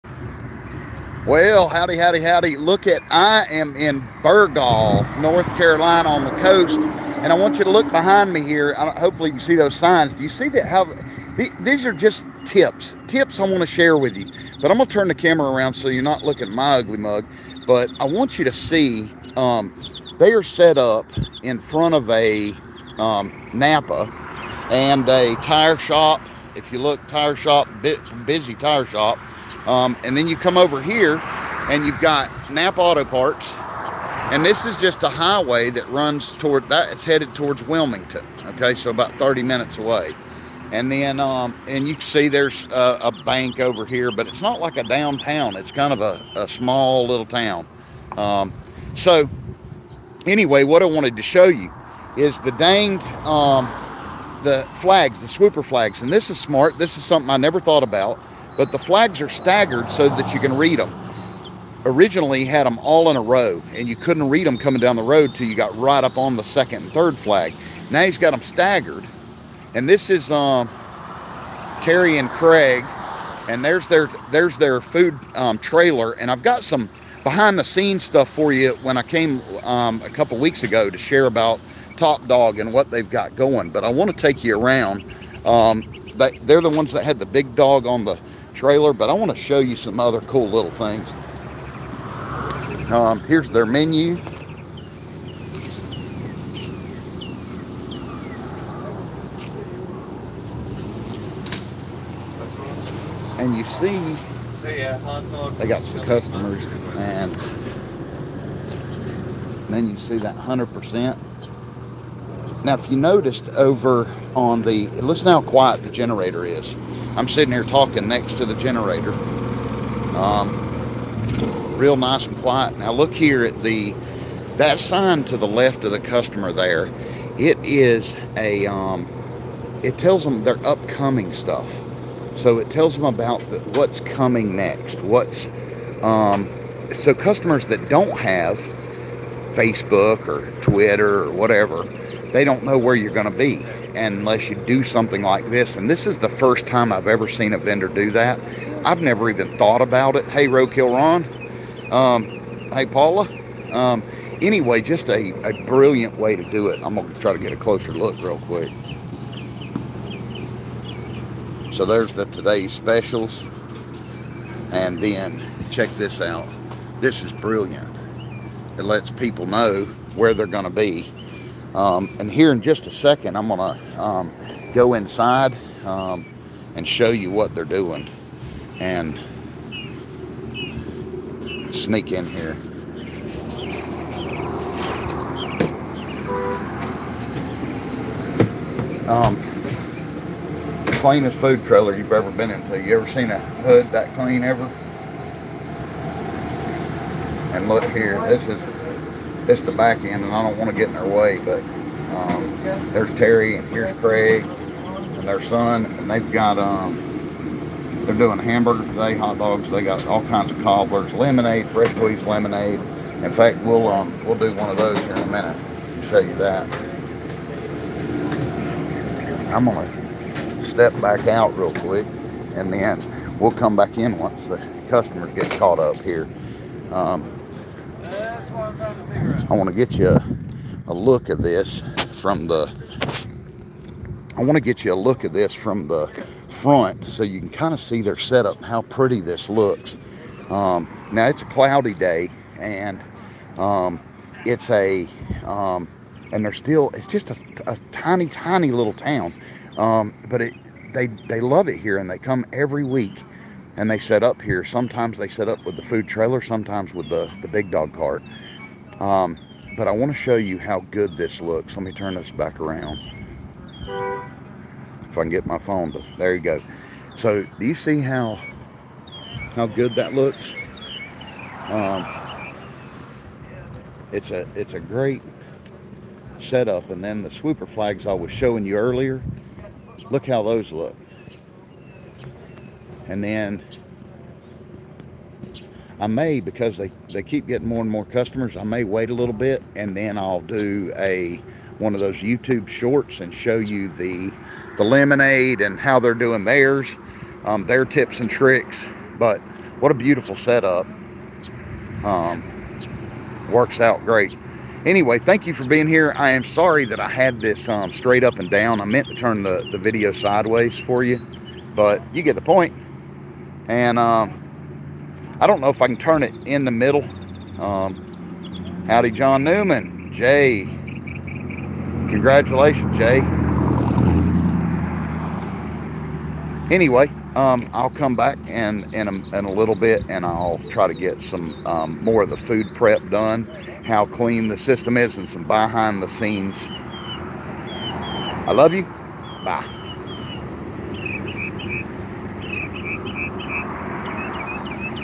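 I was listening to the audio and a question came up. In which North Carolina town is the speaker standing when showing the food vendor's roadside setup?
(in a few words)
Burgaw.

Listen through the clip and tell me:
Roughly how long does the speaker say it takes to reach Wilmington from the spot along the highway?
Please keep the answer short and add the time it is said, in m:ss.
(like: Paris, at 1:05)
30 minutes, at 0:38.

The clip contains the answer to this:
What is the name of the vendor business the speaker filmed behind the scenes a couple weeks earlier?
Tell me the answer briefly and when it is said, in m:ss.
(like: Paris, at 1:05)
Top Dog, at 1:21.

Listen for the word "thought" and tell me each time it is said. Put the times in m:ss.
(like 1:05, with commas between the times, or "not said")
0:57, 2:29.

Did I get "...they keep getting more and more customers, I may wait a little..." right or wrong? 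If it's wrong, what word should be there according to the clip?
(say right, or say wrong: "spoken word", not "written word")
right.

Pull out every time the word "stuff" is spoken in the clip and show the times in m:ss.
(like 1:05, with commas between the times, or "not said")
1:18, 2:11.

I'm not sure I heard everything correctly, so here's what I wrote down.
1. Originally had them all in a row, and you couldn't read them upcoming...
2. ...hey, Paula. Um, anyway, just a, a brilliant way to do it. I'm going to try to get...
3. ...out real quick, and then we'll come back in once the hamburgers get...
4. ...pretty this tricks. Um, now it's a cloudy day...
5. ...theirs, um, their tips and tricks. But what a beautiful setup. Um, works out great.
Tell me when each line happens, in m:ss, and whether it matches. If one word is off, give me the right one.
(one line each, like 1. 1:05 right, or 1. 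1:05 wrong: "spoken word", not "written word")
1. 1:01 wrong: "coming", not "upcoming"
2. 2:32 right
3. 3:41 wrong: "customers", not "hamburgers"
4. 3:58 wrong: "looks", not "tricks"
5. 4:56 right.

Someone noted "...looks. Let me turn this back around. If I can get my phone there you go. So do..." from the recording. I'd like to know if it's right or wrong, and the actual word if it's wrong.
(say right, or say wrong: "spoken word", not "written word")
right.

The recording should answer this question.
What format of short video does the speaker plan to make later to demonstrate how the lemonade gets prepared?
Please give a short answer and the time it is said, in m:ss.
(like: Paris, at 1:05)
YouTube shorts, at 4:52.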